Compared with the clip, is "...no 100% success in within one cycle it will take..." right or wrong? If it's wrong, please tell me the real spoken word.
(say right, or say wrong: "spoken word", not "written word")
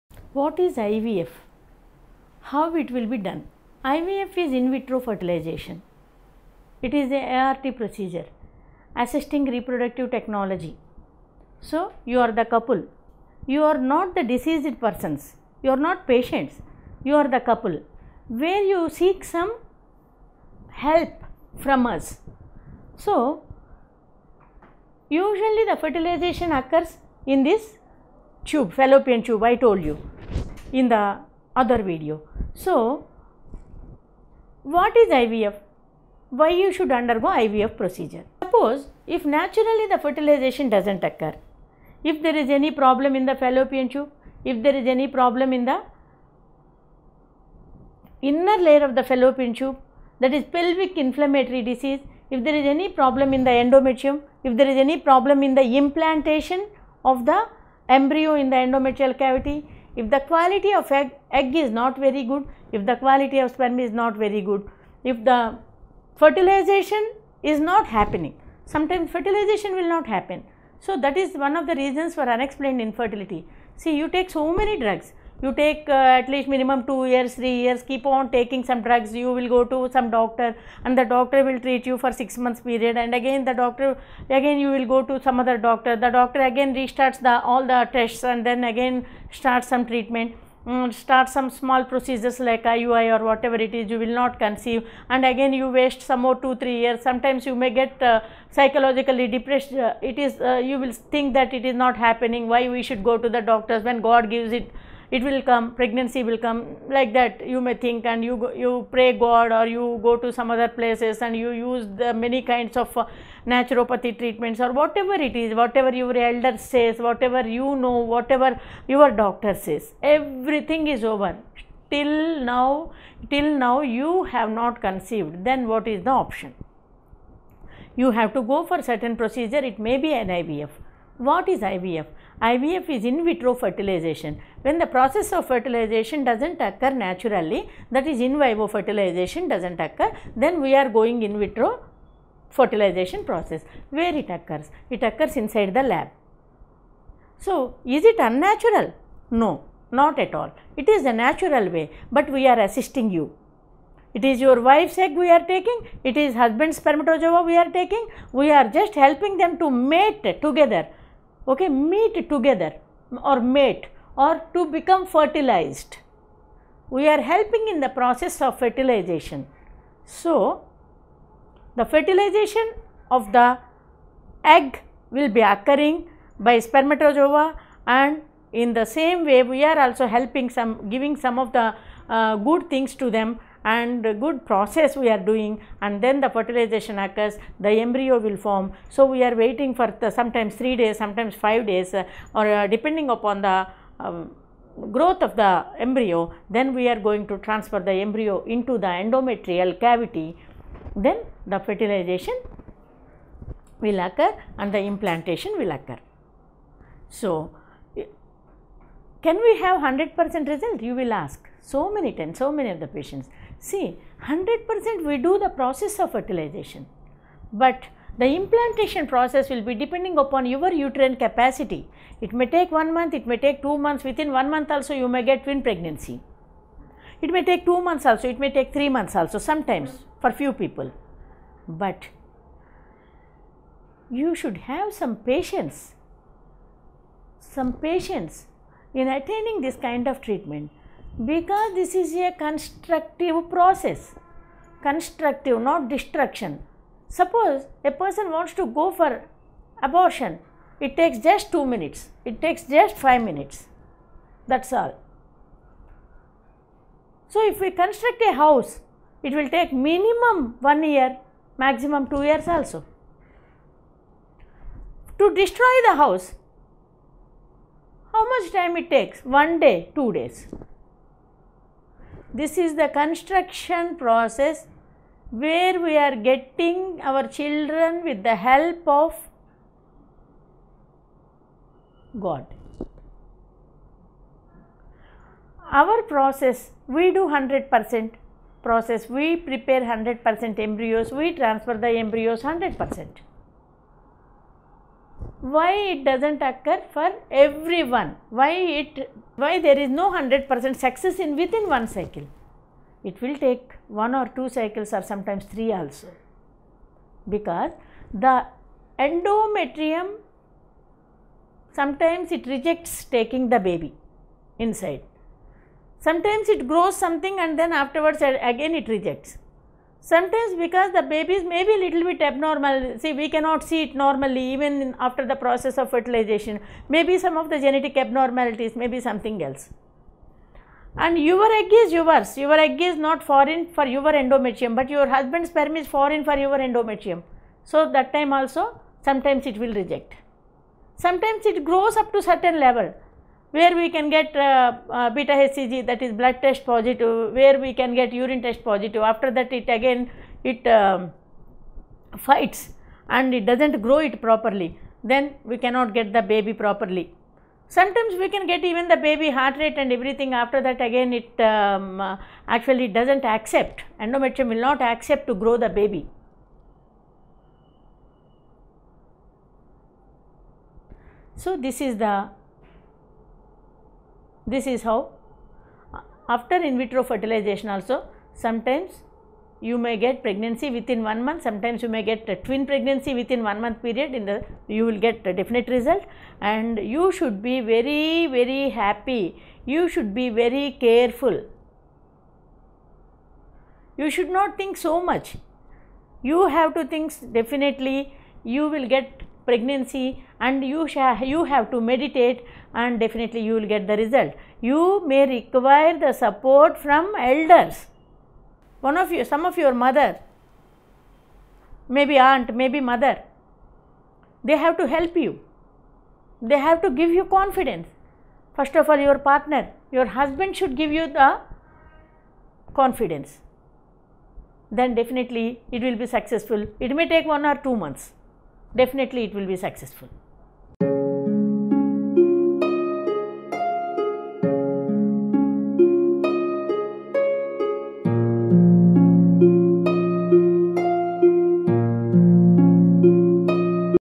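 right.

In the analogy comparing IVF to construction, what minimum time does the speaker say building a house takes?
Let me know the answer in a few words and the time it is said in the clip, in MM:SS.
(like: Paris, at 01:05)
1 year, at 04:19.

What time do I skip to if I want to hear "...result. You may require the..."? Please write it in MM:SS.
06:43.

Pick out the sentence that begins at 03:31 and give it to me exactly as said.
So many times, so many of the patients.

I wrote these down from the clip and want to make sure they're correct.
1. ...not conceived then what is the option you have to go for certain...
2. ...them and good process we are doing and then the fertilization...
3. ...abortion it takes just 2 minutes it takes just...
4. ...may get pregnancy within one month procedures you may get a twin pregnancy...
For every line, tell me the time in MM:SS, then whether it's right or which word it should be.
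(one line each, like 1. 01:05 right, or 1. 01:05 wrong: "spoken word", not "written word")
1. 02:04 right
2. 03:03 right
3. 04:09 right
4. 06:19 wrong: "sometimes", not "procedures".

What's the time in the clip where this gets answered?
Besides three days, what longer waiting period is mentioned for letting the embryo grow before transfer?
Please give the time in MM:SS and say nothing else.
03:11.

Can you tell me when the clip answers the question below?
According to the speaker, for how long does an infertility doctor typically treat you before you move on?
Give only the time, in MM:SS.
01:22.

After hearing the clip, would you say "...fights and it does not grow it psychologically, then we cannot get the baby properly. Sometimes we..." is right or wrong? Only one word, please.
wrong.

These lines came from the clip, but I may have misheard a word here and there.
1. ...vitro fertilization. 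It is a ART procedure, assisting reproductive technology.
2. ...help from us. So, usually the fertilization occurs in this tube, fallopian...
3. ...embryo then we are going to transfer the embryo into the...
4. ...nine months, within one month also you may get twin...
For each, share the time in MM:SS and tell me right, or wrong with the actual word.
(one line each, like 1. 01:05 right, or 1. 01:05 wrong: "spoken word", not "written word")
1. 00:04 right
2. 00:20 right
3. 03:15 right
4. 03:43 wrong: "two", not "nine".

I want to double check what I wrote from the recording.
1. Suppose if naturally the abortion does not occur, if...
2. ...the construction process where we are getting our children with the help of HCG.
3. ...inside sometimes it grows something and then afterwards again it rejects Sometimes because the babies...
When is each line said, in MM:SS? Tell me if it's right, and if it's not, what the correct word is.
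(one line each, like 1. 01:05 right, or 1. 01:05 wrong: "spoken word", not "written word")
1. 00:38 wrong: "fertilization", not "abortion"
2. 04:32 wrong: "God", not "HCG"
3. 05:14 right.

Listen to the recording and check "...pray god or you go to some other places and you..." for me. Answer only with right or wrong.
right.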